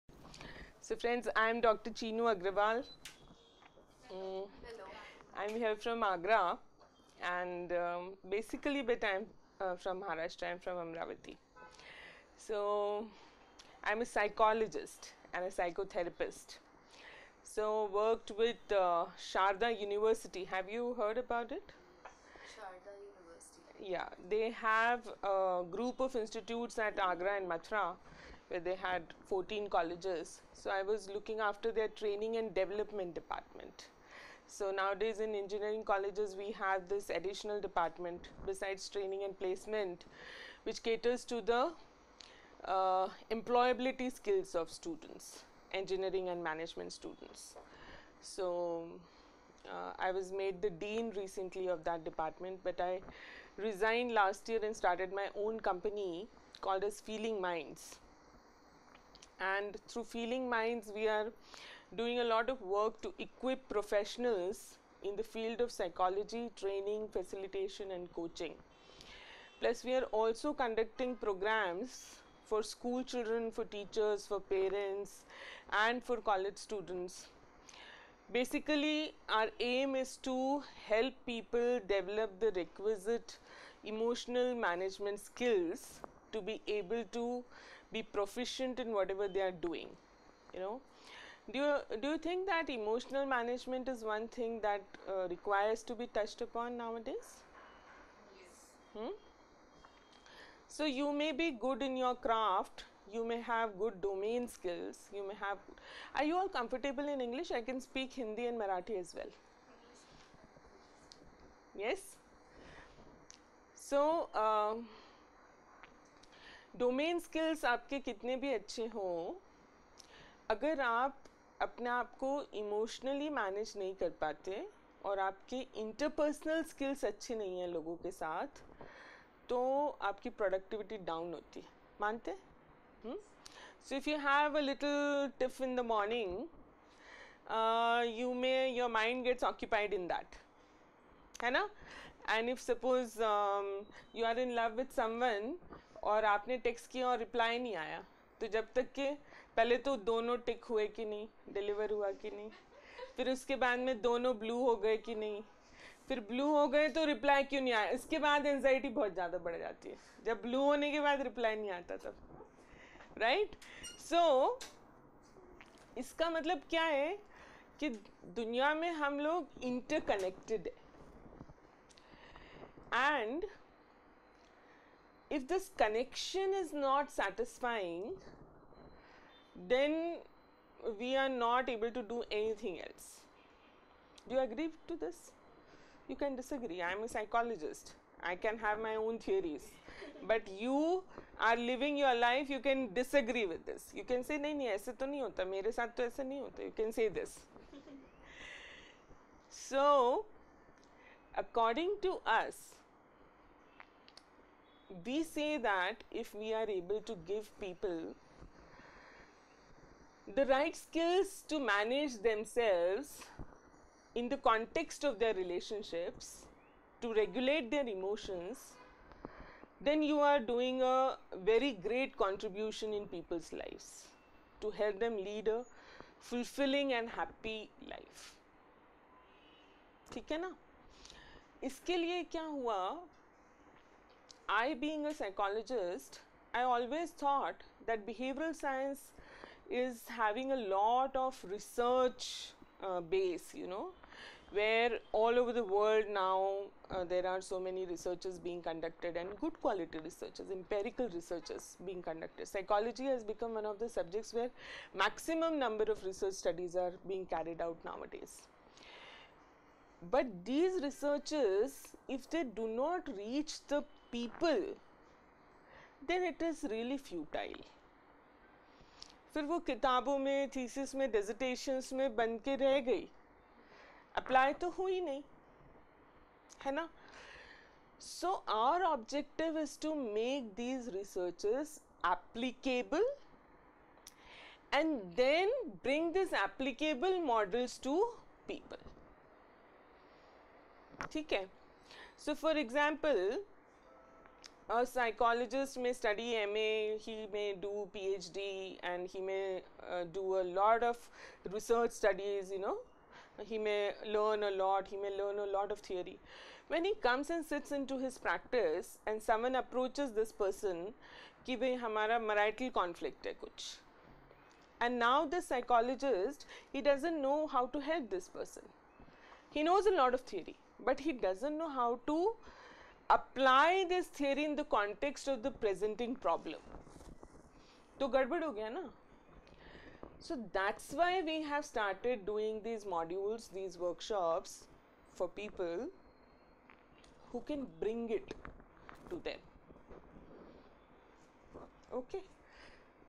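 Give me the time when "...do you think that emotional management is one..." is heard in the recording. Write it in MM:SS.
01:32.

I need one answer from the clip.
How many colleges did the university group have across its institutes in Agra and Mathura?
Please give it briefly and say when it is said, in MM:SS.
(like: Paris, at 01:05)
14, at 00:29.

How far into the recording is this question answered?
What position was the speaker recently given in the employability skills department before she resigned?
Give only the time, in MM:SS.
00:50.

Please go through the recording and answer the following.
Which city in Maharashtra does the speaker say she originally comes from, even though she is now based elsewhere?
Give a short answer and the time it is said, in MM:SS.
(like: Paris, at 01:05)
Amravati, at 00:10.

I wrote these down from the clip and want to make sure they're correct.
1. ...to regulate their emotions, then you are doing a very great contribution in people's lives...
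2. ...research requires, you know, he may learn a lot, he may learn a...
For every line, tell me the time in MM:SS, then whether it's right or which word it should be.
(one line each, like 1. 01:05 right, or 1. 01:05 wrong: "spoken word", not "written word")
1. 03:37 right
2. 05:01 wrong: "studies", not "requires".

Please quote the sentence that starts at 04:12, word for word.
Psychology has become one of the subjects where maximum number of research studies are being carried out nowadays.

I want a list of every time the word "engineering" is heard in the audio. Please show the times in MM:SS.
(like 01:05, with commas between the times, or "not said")
00:35, 00:45.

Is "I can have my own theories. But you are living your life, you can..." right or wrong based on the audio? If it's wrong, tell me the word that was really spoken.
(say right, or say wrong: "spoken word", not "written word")
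right.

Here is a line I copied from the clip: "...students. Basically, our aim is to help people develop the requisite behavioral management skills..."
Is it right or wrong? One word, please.
wrong.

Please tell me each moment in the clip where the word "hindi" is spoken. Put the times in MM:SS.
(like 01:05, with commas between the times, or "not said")
01:48.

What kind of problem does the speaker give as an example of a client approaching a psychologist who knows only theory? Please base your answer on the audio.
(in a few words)
Marital conflict.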